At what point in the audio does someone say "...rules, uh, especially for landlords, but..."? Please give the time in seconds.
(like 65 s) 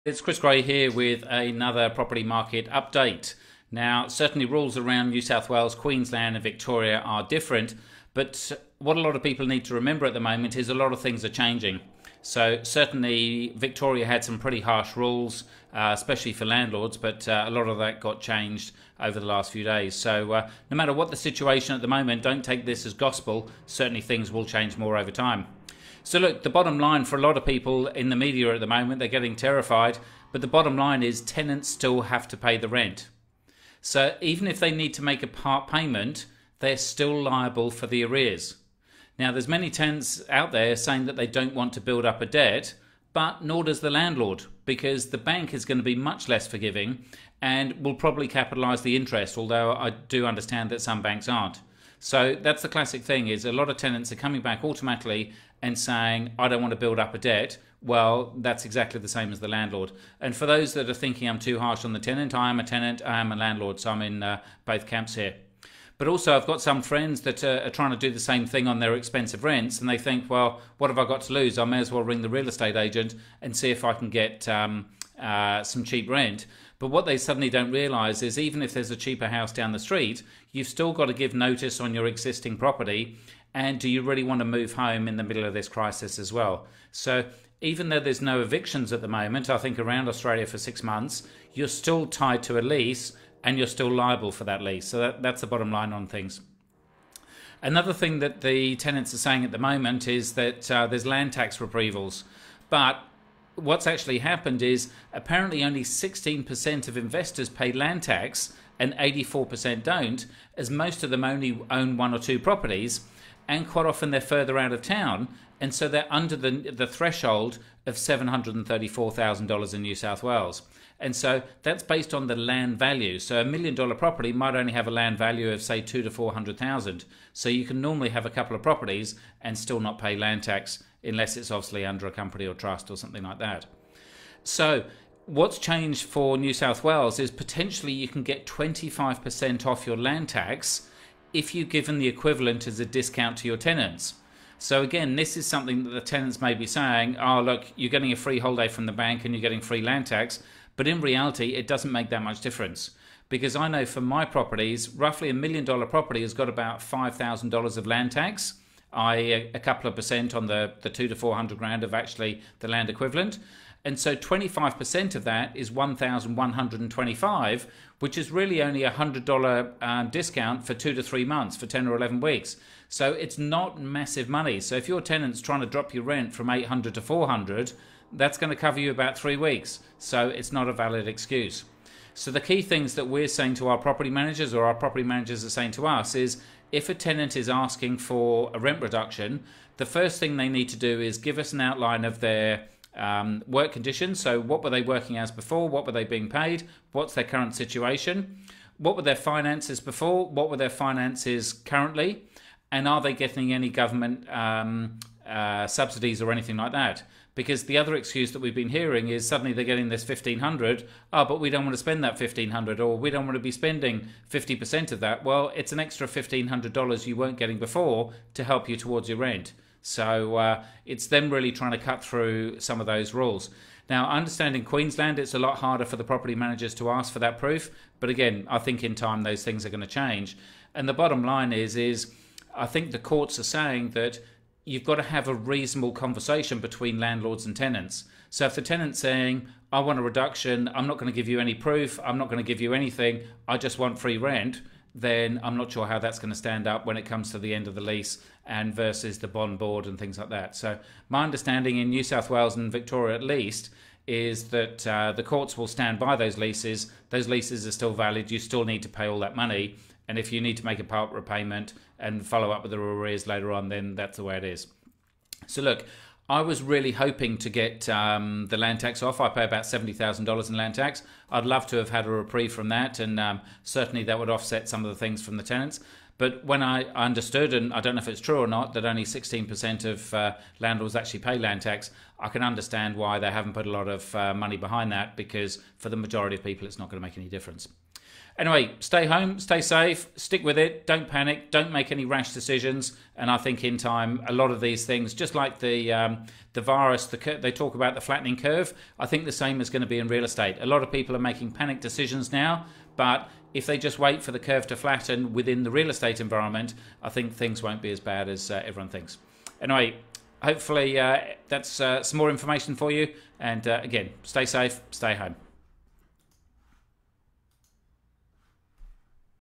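14 s.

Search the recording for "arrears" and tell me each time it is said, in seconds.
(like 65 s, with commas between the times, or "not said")
38 s, 262 s.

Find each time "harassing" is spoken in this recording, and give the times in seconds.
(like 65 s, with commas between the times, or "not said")
not said.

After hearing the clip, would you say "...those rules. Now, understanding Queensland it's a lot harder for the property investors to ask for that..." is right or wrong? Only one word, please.
wrong.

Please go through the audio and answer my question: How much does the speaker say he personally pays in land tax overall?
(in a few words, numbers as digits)
$70,000.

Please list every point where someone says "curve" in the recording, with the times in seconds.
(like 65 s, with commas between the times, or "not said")
298 s, 304 s.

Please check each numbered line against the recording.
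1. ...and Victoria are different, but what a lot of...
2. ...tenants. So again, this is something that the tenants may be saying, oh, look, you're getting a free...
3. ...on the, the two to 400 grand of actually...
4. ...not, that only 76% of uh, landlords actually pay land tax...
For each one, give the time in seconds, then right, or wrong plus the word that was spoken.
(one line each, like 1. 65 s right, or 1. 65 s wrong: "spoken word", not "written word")
1. 6 s right
2. 143 s right
3. 160 s right
4. 278 s wrong: "16", not "76".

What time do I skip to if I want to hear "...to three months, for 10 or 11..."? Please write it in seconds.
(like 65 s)
170 s.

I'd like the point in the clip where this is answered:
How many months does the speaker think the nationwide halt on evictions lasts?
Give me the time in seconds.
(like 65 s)
90 s.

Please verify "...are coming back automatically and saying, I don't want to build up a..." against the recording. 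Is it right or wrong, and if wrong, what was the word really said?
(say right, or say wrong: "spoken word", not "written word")
right.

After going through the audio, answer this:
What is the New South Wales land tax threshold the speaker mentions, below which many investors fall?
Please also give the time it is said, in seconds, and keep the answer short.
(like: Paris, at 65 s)
$734,000, at 117 s.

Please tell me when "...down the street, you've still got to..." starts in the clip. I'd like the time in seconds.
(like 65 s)
79 s.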